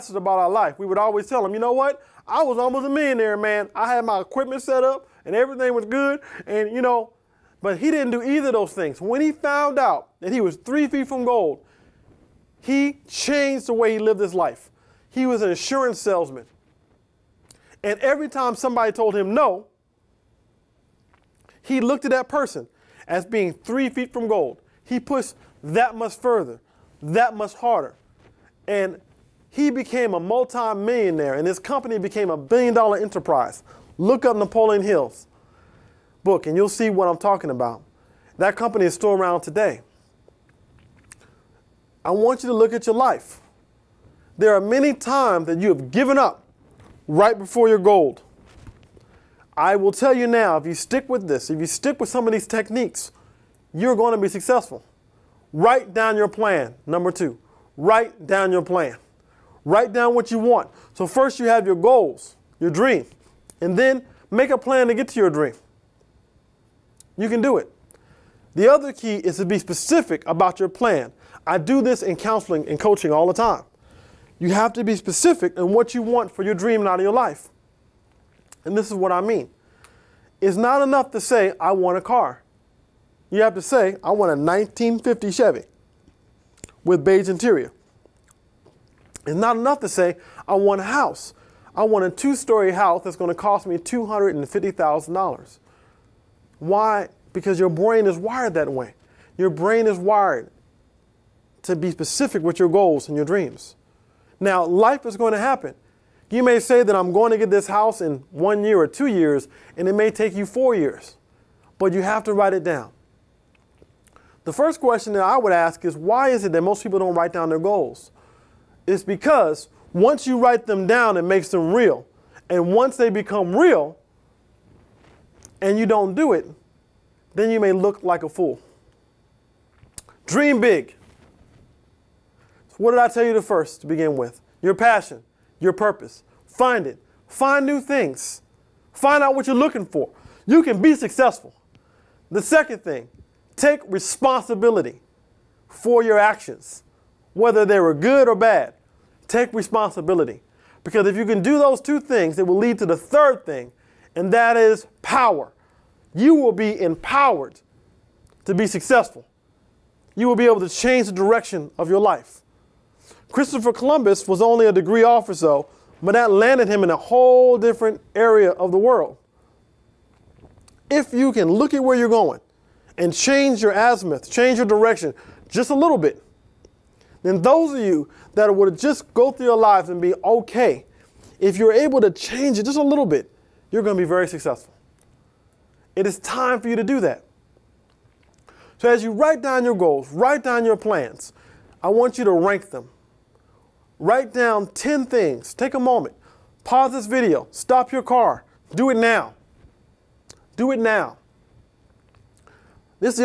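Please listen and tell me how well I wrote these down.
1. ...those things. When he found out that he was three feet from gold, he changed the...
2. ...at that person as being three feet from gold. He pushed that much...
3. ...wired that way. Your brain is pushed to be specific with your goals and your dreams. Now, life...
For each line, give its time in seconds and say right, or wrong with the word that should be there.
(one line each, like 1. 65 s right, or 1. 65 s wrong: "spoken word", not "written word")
1. 8 s right
2. 22 s right
3. 98 s wrong: "wired", not "pushed".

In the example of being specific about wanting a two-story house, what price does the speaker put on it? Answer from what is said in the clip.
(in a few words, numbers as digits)
$250,000.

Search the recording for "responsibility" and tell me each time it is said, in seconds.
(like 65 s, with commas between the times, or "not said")
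143 s, 149 s.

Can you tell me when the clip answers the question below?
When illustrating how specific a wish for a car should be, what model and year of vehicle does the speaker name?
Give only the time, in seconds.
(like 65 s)
84 s.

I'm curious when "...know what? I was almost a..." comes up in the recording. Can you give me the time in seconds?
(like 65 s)
1 s.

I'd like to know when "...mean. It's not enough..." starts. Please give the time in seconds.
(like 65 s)
79 s.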